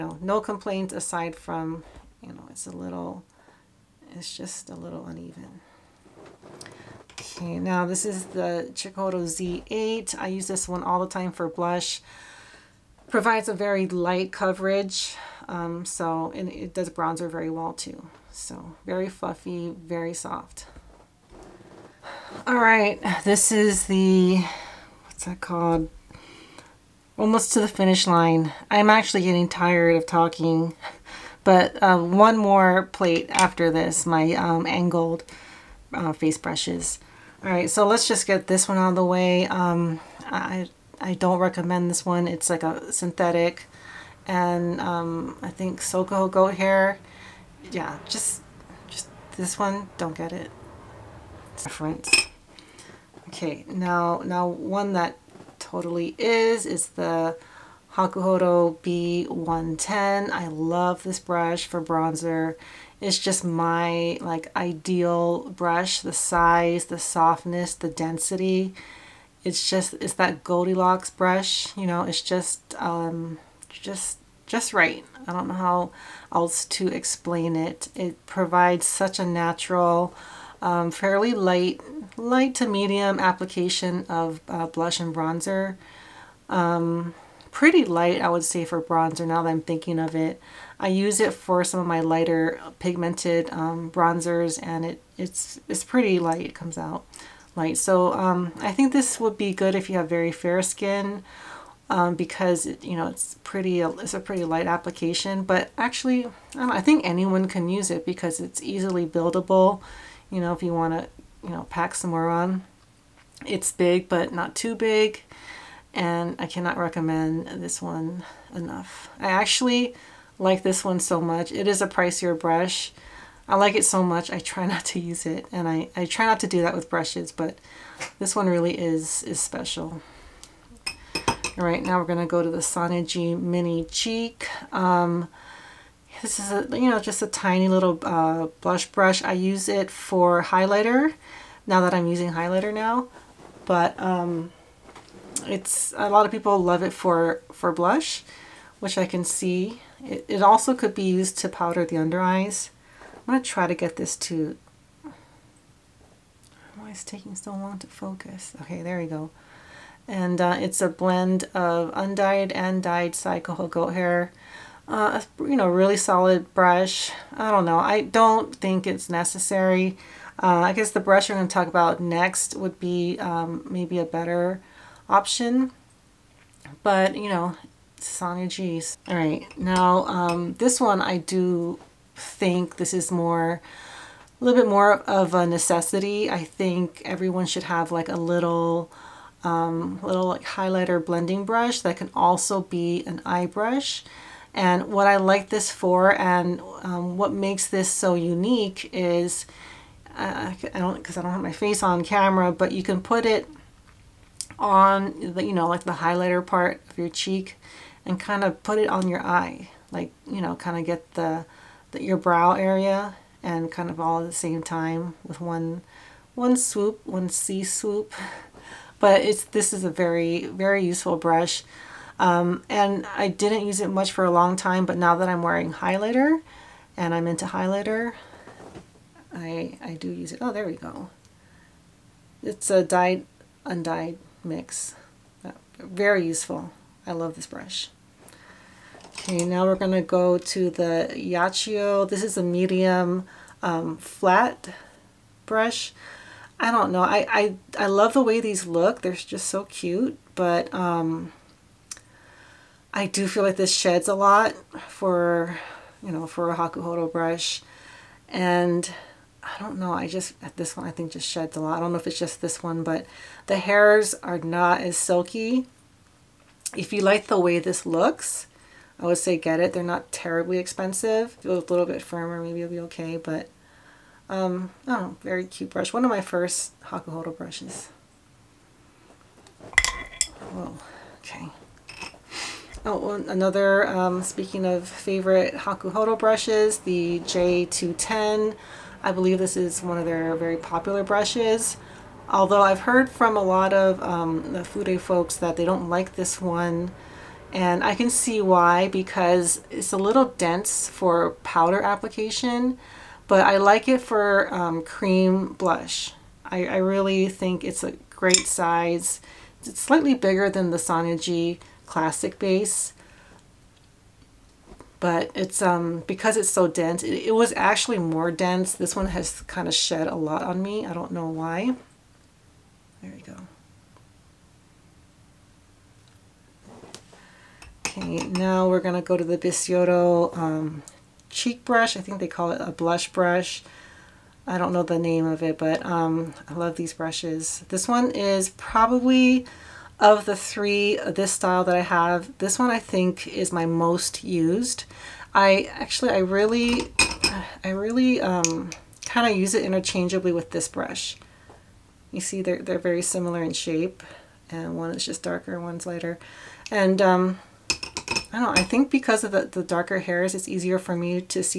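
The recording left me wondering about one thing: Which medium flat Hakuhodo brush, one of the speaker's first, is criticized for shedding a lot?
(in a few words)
Yachiyo.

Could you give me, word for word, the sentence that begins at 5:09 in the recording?
It's slightly bigger than the Sonia G Classic base, but it's um, because it's so dense.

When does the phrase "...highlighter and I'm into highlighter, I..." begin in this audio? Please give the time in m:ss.
3:45.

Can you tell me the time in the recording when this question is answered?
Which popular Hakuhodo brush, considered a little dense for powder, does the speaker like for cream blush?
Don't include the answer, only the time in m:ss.
4:47.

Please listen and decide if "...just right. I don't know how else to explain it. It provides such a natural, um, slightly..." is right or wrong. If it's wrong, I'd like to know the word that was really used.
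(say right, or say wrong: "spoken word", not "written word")
wrong: "fairly", not "slightly".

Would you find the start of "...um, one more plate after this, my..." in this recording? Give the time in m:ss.
0:31.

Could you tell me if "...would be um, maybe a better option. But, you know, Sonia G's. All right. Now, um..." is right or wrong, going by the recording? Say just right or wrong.
right.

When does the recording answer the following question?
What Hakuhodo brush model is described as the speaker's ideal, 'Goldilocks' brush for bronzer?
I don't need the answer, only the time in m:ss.
0:58.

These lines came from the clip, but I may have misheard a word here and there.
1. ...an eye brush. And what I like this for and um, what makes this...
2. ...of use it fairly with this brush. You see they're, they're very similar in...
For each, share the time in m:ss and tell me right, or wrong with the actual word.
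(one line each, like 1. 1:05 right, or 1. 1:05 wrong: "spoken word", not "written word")
1. 3:13 right
2. 5:49 wrong: "interchangeably", not "fairly".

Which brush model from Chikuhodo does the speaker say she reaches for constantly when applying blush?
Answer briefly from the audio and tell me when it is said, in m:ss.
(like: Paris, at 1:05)
Z8, at 0:09.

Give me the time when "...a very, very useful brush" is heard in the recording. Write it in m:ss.
3:39.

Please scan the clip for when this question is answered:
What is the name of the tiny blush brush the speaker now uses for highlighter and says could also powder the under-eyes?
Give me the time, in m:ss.
2:13.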